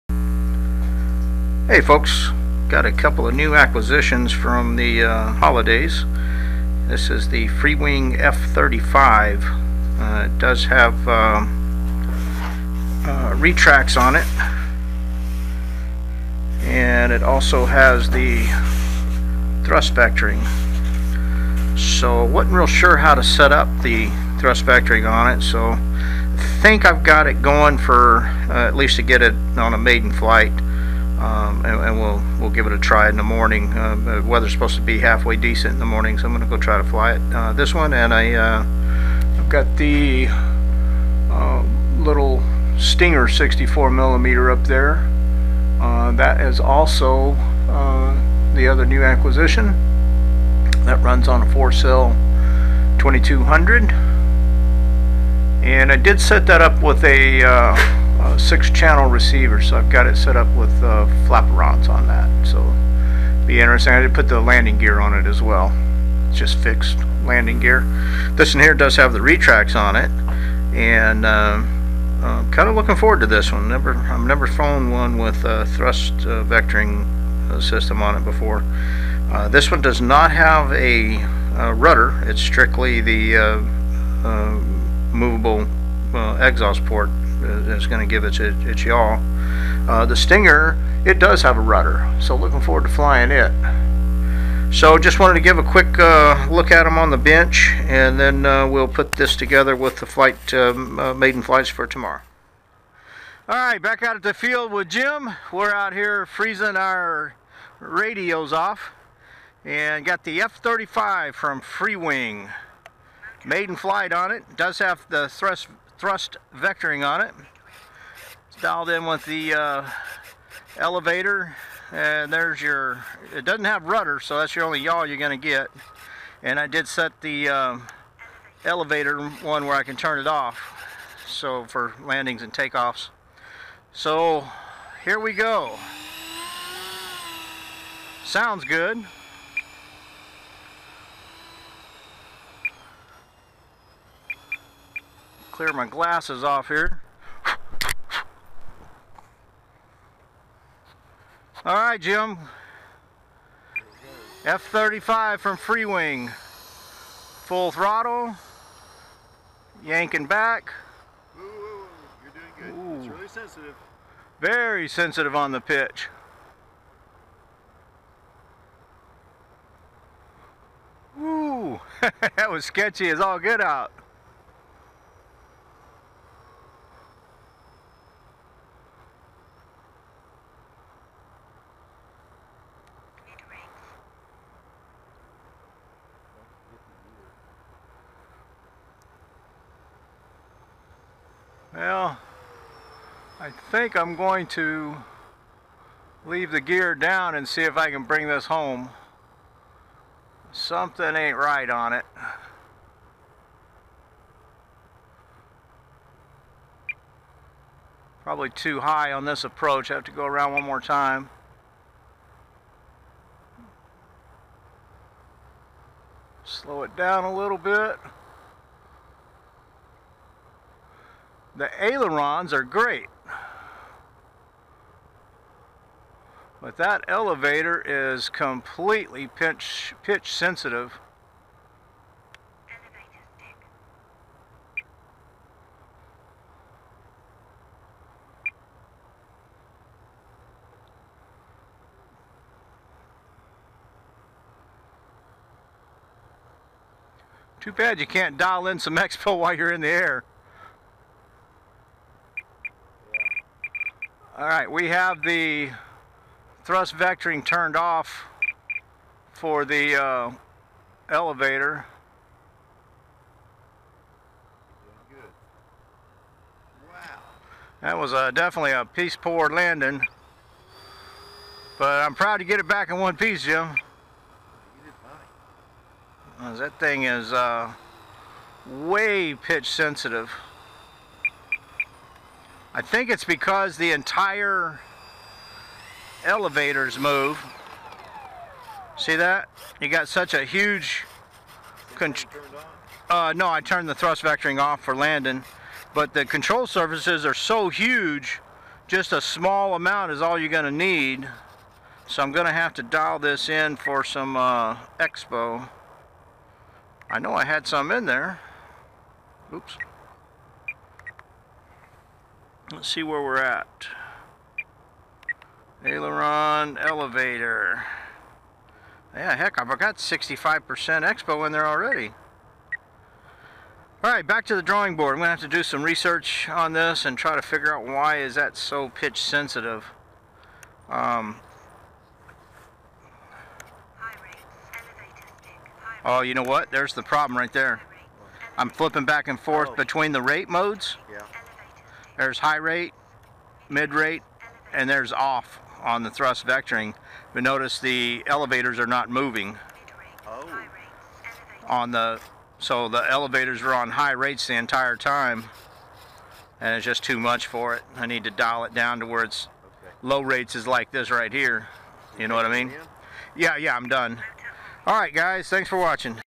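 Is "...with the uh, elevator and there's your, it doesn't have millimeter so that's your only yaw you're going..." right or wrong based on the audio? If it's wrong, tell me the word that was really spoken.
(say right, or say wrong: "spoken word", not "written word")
wrong: "rudder", not "millimeter".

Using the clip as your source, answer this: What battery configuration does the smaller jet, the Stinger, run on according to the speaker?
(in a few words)
4 cell 2200.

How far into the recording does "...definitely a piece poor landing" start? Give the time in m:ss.
4:28.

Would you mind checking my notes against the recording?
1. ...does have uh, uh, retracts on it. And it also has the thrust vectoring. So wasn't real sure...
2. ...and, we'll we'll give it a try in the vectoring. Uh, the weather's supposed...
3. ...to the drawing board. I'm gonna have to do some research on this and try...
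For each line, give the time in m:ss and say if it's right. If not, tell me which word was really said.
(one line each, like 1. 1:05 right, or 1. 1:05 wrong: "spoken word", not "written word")
1. 0:10 right
2. 0:31 wrong: "morning", not "vectoring"
3. 5:24 right.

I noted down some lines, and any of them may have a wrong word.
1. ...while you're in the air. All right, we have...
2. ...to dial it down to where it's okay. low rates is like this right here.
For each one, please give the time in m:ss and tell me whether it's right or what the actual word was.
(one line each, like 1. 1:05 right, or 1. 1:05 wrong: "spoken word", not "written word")
1. 4:09 right
2. 5:58 right.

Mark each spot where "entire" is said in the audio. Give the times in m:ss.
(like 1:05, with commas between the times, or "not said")
4:43, 5:54.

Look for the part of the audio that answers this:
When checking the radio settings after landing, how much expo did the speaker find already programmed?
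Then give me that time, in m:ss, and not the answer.
5:19.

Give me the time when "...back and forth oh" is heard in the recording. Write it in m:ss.
5:39.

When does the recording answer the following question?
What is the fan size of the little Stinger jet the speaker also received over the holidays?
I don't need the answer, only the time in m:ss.
0:43.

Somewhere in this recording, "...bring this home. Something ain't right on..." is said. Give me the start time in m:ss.
3:18.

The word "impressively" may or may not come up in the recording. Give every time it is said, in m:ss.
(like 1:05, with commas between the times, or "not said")
not said.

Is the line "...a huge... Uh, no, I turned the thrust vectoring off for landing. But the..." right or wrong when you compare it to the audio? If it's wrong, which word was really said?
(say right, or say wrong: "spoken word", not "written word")
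right.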